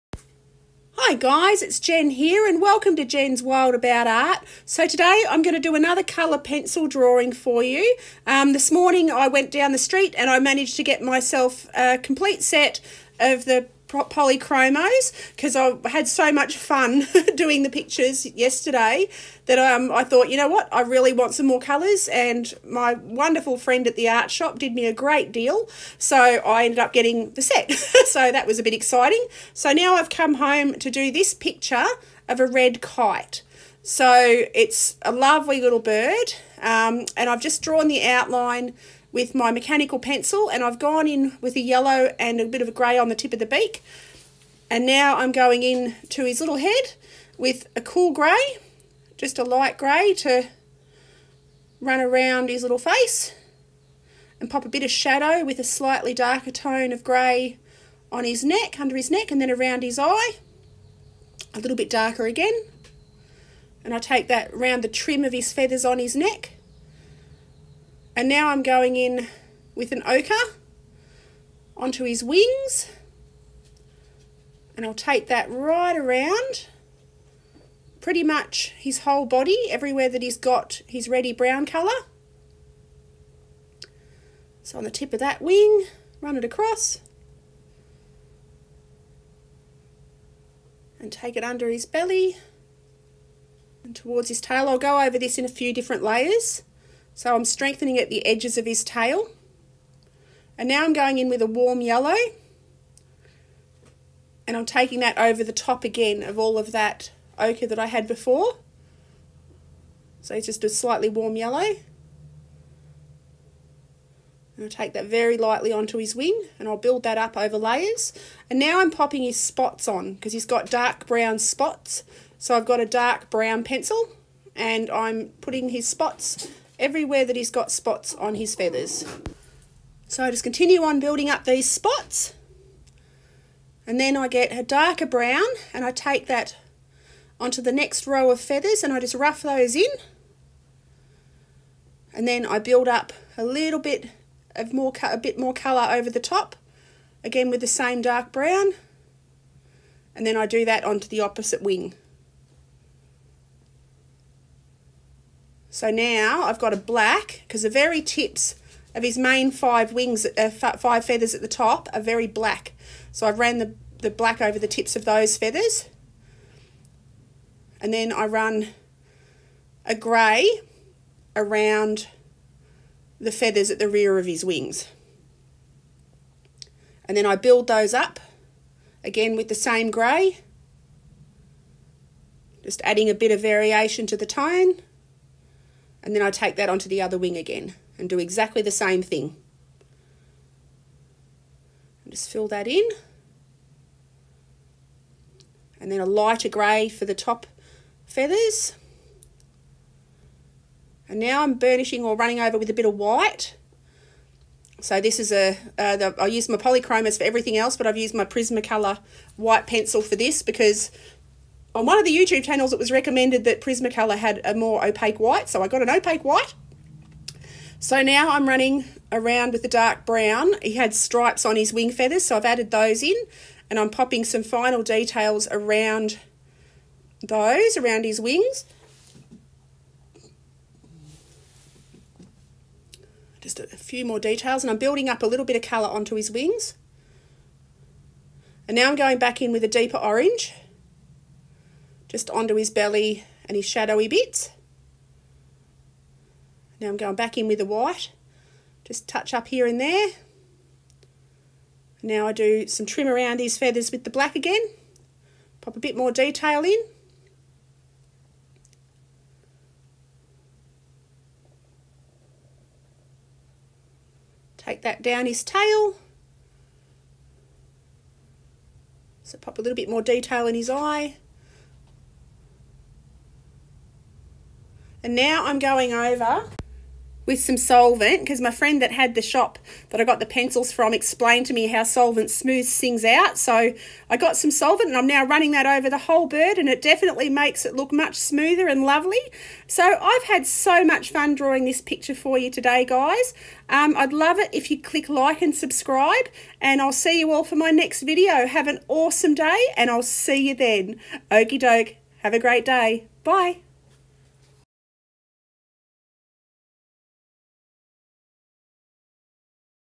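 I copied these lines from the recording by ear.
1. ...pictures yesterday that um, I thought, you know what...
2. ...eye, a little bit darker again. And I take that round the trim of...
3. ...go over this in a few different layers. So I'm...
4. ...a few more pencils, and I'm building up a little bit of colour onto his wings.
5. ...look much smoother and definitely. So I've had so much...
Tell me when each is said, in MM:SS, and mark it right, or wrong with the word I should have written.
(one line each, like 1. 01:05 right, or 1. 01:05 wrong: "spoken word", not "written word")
1. 00:17 right
2. 00:59 right
3. 01:34 right
4. 03:53 wrong: "details", not "pencils"
5. 04:47 wrong: "lovely", not "definitely".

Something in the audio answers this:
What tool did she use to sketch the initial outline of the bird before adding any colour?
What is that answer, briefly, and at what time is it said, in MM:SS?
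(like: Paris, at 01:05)
Mechanical pencil, at 00:39.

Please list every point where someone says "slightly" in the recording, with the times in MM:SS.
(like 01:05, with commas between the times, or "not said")
00:55, 01:50.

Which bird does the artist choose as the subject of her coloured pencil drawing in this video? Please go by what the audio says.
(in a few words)
Red kite.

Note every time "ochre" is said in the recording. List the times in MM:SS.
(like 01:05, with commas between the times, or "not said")
01:10, 01:47.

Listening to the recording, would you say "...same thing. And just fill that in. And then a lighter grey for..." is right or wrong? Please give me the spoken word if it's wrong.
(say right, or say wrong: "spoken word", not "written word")
right.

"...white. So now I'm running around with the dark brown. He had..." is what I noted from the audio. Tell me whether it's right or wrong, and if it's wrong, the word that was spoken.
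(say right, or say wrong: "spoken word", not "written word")
right.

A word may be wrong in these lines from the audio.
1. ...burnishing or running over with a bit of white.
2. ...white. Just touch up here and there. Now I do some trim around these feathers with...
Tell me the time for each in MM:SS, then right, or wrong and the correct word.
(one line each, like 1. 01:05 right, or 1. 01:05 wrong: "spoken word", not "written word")
1. 03:21 right
2. 04:07 right.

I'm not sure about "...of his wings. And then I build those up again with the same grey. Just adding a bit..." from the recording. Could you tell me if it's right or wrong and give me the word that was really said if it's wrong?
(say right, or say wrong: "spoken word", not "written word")
right.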